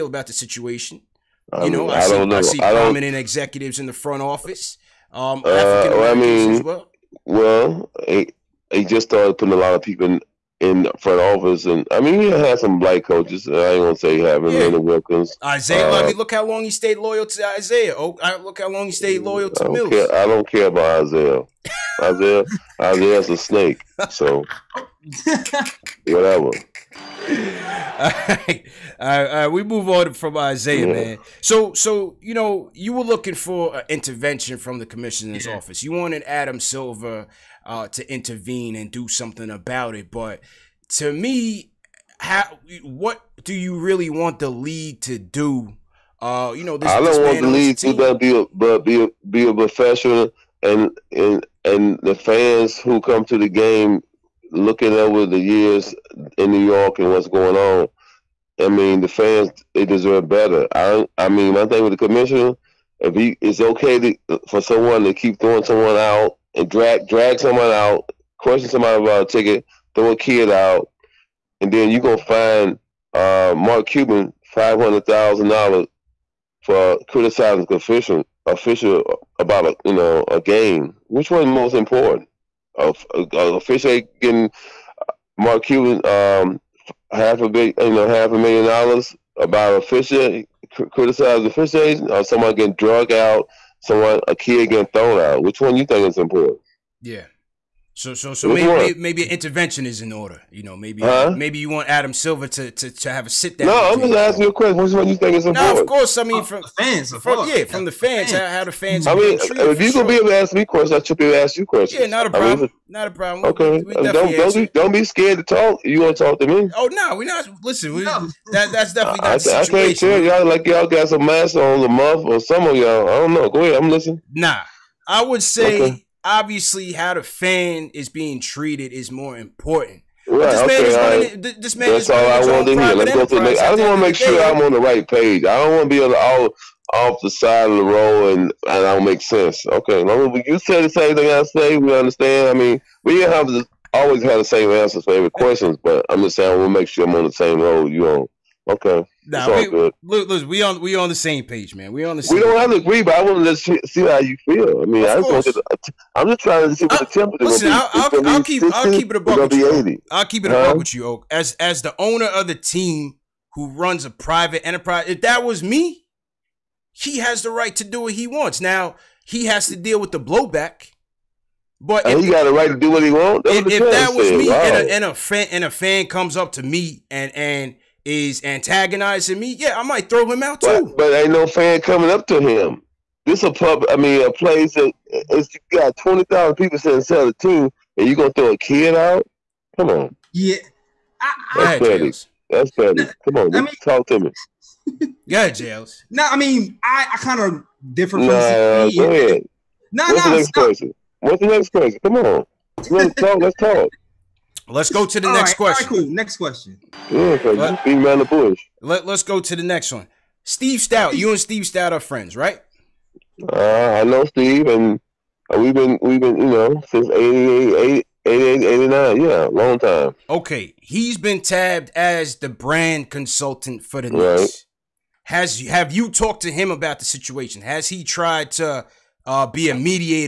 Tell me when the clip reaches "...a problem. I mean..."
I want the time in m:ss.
1:52.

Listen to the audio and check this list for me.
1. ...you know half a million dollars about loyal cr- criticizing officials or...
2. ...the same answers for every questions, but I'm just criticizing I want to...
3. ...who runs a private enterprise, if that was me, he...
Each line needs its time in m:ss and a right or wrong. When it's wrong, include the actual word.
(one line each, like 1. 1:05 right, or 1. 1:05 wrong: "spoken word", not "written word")
1. 1:27 wrong: "official", not "loyal"
2. 2:24 wrong: "saying", not "criticizing"
3. 2:43 right.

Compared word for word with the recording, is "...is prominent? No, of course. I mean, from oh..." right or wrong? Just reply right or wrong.
wrong.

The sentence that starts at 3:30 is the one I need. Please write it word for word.
Steve Stoute, you and Steve Stoute are friends, right?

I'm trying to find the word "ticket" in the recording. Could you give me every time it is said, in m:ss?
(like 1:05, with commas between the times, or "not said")
1:09.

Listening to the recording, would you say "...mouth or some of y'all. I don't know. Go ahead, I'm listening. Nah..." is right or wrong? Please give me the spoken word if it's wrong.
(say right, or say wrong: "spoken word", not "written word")
right.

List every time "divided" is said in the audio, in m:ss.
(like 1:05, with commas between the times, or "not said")
not said.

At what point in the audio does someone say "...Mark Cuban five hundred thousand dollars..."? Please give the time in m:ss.
1:13.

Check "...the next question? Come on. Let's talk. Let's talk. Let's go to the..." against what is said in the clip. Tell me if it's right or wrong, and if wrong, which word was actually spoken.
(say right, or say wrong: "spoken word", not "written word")
right.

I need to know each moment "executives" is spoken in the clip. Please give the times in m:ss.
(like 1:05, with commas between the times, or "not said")
0:03.